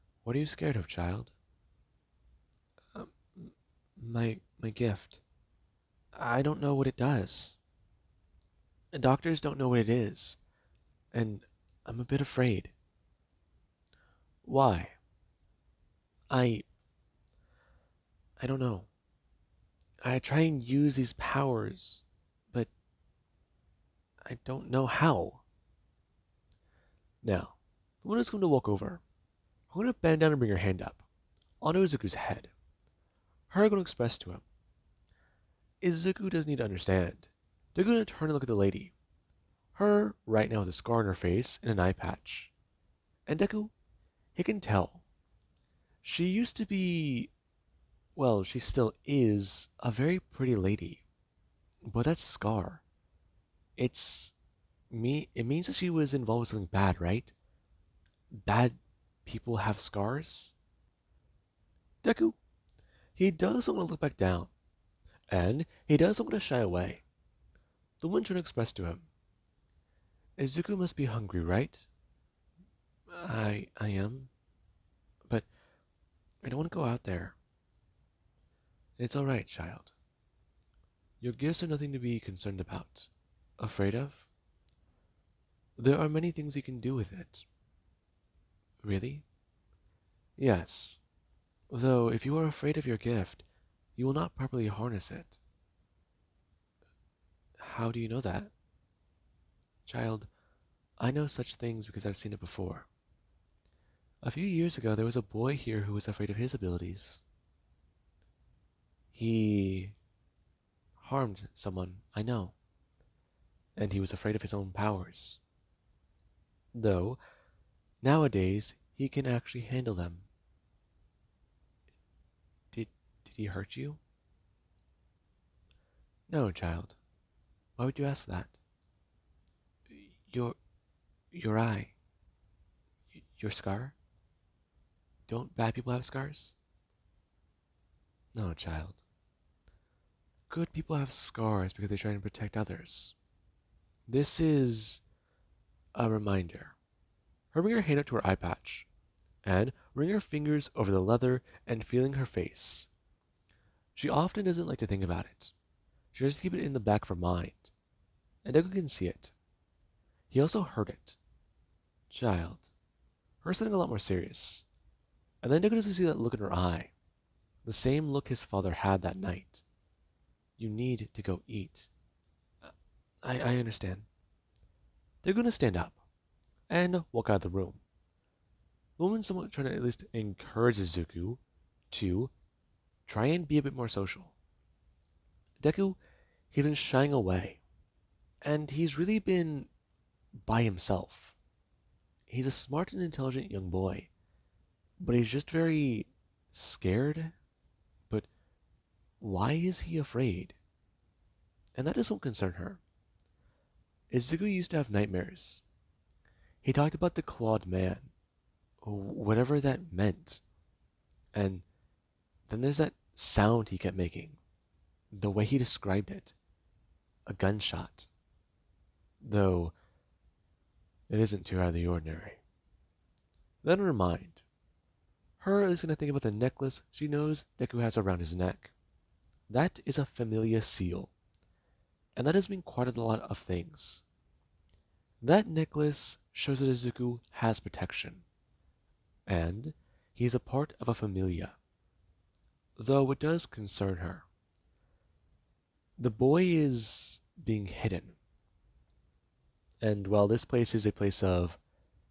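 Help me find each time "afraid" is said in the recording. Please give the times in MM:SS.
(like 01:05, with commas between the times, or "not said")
00:12, 01:23, 01:32, 01:46, 01:54, 03:19.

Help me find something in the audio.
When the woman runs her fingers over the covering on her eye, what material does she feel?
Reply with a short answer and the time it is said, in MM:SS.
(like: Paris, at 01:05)
leather, at 02:31.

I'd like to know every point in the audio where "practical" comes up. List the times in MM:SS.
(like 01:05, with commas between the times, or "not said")
not said.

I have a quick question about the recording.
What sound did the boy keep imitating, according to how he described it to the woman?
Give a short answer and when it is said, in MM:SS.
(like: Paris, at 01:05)
a gunshot, at 03:37.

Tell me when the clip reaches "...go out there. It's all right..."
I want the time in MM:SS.
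01:16.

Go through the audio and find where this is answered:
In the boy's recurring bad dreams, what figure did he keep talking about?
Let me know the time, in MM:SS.
03:27.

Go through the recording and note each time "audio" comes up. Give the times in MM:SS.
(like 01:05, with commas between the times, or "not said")
not said.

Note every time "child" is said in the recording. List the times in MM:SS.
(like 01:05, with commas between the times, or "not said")
00:00, 01:19, 01:39, 02:06, 02:18, 02:42.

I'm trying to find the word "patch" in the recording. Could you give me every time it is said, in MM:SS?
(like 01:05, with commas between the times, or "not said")
00:41, 02:28.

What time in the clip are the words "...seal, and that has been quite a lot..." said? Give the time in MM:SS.
03:50.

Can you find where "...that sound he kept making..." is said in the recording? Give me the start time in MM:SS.
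03:32.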